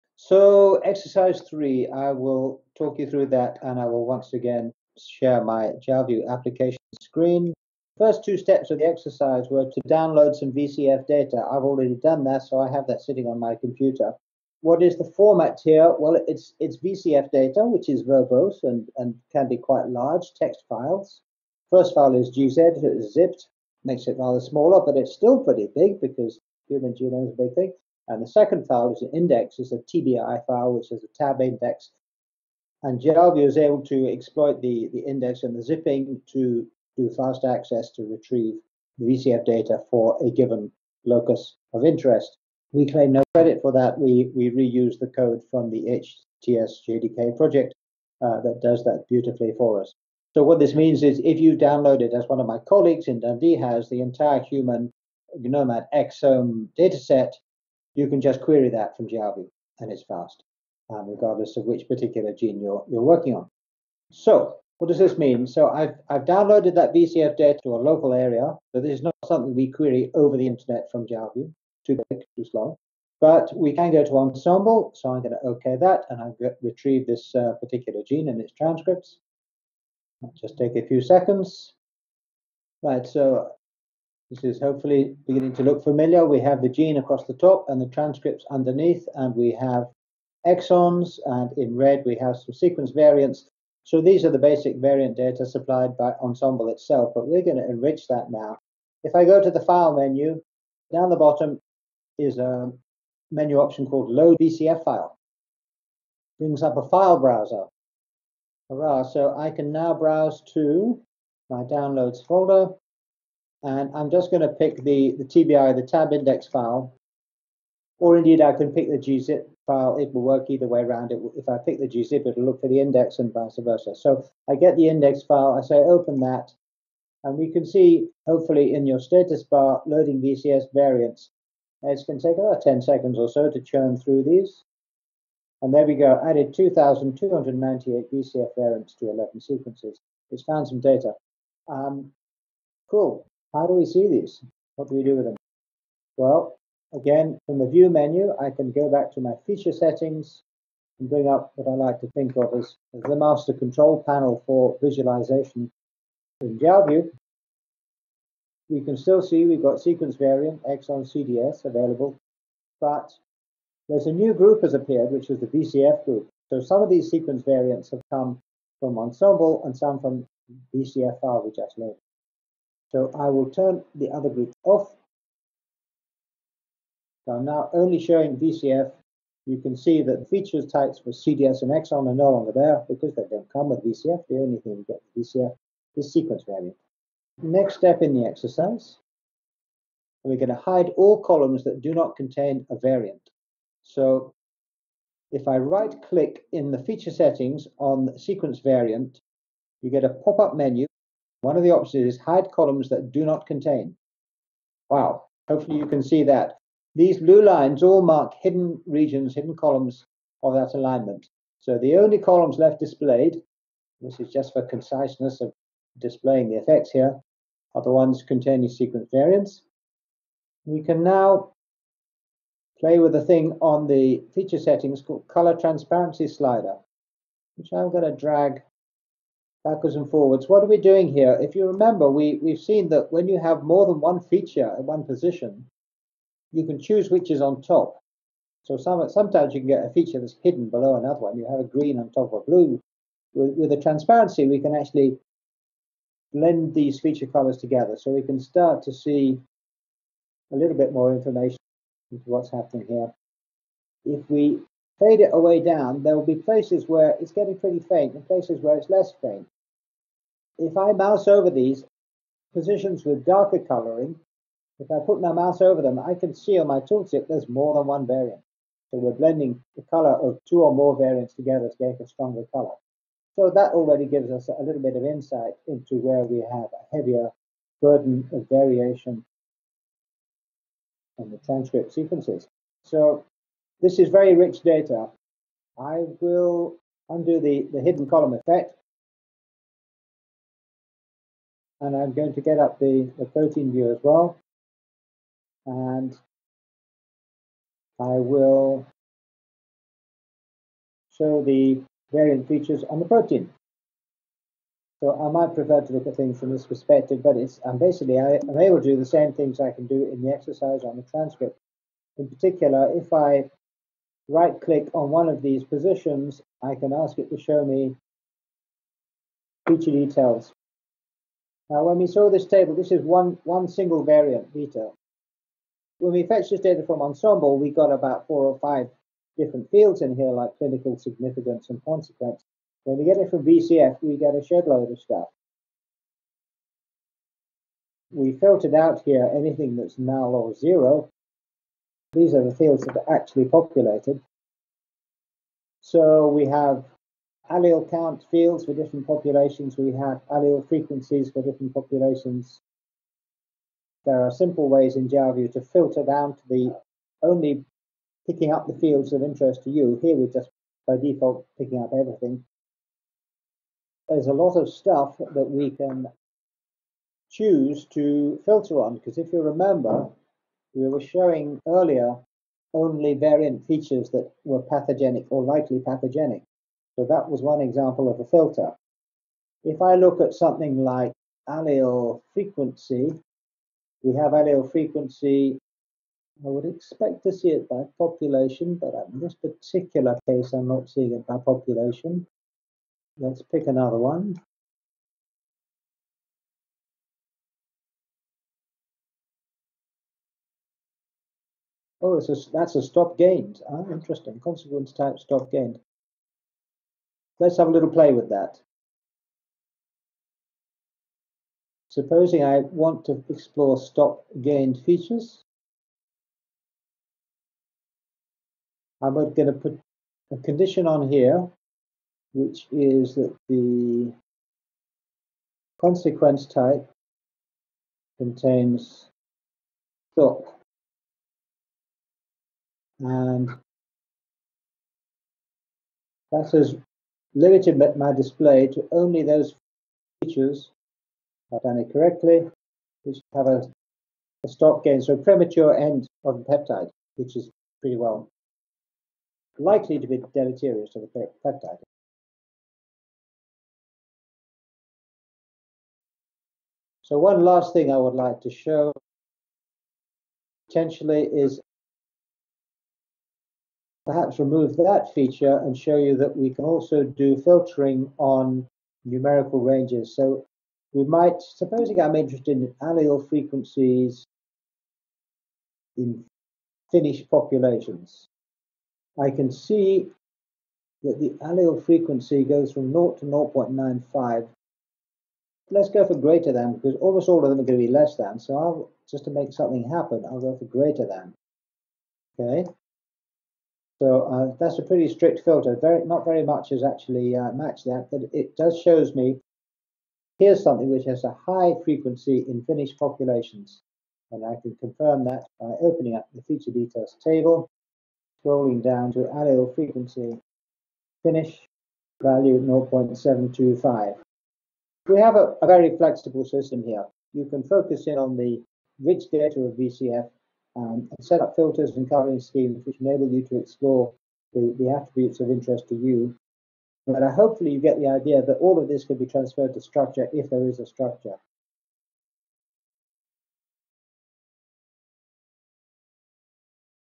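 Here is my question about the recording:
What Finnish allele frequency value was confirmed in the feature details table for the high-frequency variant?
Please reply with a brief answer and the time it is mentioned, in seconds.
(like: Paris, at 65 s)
0.725, at 512 s.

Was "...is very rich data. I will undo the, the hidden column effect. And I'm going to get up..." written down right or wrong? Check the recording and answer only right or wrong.
right.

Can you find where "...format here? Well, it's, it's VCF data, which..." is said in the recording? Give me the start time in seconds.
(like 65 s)
15 s.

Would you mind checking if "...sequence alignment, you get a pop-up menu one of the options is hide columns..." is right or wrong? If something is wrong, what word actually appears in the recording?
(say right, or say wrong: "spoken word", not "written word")
wrong: "variant", not "alignment".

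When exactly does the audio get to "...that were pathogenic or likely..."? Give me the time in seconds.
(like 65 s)
374 s.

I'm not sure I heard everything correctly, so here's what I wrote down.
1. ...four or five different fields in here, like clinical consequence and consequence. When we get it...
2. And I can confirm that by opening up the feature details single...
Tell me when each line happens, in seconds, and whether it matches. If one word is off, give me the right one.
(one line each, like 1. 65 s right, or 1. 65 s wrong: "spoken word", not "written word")
1. 328 s wrong: "significance", not "consequence"
2. 504 s wrong: "table", not "single".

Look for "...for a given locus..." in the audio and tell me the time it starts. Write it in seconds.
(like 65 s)
39 s.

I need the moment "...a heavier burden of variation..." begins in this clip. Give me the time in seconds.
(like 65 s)
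276 s.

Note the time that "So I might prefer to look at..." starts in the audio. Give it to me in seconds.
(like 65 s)
304 s.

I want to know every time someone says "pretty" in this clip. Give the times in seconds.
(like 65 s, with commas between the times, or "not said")
25 s, 257 s, 447 s, 494 s.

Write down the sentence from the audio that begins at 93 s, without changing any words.
So these are the basic variant data supplied by Ensembl itself, but we're going to enrich that now.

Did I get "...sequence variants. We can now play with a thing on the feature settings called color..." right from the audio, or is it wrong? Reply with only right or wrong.
right.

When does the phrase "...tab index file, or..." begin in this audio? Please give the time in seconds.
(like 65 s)
115 s.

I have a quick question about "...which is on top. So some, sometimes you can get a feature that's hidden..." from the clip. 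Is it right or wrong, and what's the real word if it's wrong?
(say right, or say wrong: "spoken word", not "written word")
right.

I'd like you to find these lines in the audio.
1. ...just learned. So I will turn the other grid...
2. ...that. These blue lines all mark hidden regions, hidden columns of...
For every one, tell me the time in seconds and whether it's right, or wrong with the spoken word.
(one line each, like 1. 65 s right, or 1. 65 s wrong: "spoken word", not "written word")
1. 171 s right
2. 206 s right.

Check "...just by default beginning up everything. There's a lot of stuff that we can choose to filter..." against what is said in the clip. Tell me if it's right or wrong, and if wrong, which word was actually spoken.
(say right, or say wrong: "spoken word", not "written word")
wrong: "picking", not "beginning".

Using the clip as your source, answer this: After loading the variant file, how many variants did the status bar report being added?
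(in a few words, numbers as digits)
2,298.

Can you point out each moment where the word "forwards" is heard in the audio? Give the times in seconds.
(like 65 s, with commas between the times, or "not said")
230 s.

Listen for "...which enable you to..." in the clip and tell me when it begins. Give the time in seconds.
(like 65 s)
522 s.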